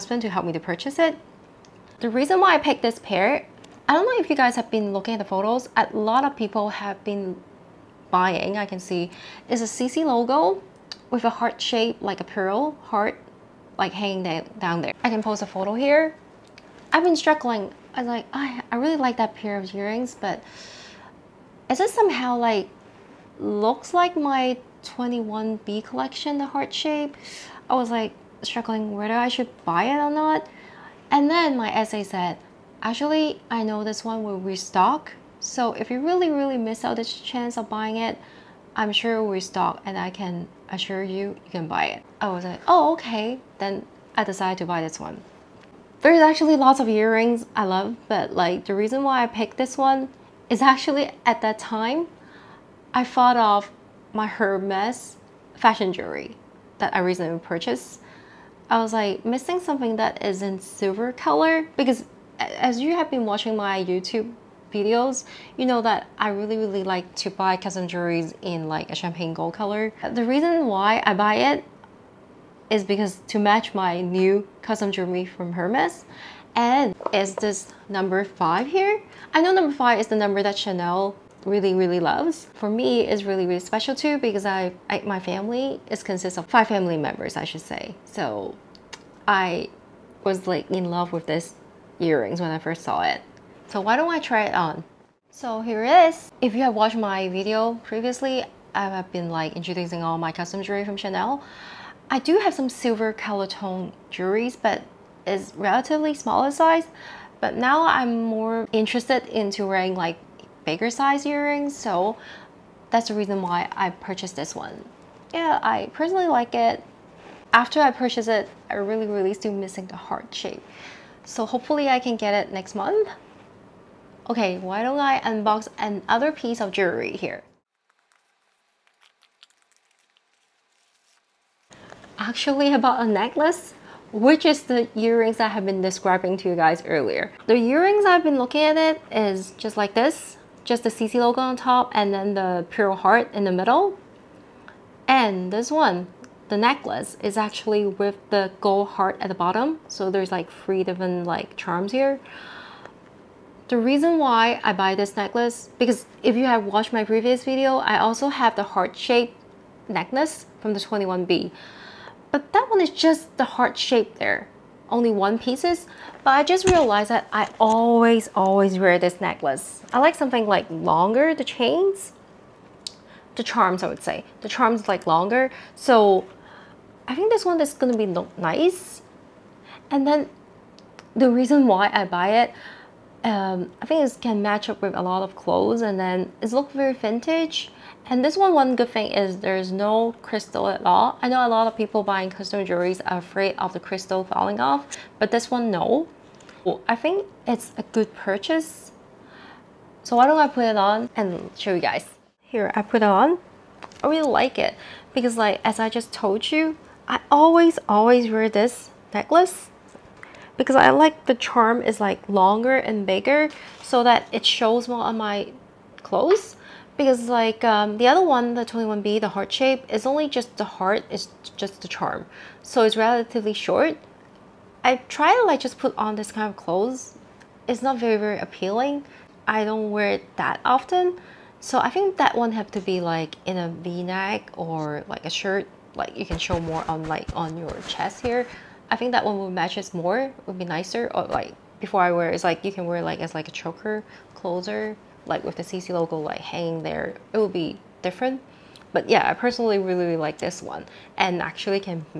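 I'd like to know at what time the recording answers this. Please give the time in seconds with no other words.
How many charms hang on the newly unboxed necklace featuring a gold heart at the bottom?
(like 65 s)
150 s.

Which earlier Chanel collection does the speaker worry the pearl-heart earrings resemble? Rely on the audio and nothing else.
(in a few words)
21B.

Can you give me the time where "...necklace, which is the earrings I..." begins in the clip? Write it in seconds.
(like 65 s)
133 s.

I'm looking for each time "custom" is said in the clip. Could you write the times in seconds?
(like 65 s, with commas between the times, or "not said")
67 s, 74 s, 100 s, 192 s.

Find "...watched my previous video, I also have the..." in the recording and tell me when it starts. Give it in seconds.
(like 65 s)
156 s.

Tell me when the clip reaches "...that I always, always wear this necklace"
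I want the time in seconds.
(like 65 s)
167 s.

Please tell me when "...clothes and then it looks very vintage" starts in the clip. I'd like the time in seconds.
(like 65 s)
185 s.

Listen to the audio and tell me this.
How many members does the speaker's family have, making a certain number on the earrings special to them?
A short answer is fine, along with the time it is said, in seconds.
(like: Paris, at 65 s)
5, at 86 s.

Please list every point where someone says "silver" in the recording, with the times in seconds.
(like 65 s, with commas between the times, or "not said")
60 s, 102 s.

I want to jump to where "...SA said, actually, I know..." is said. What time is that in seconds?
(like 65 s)
31 s.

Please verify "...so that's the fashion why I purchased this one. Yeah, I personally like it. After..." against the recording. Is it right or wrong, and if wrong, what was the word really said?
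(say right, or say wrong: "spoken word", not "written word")
wrong: "reason", not "fashion".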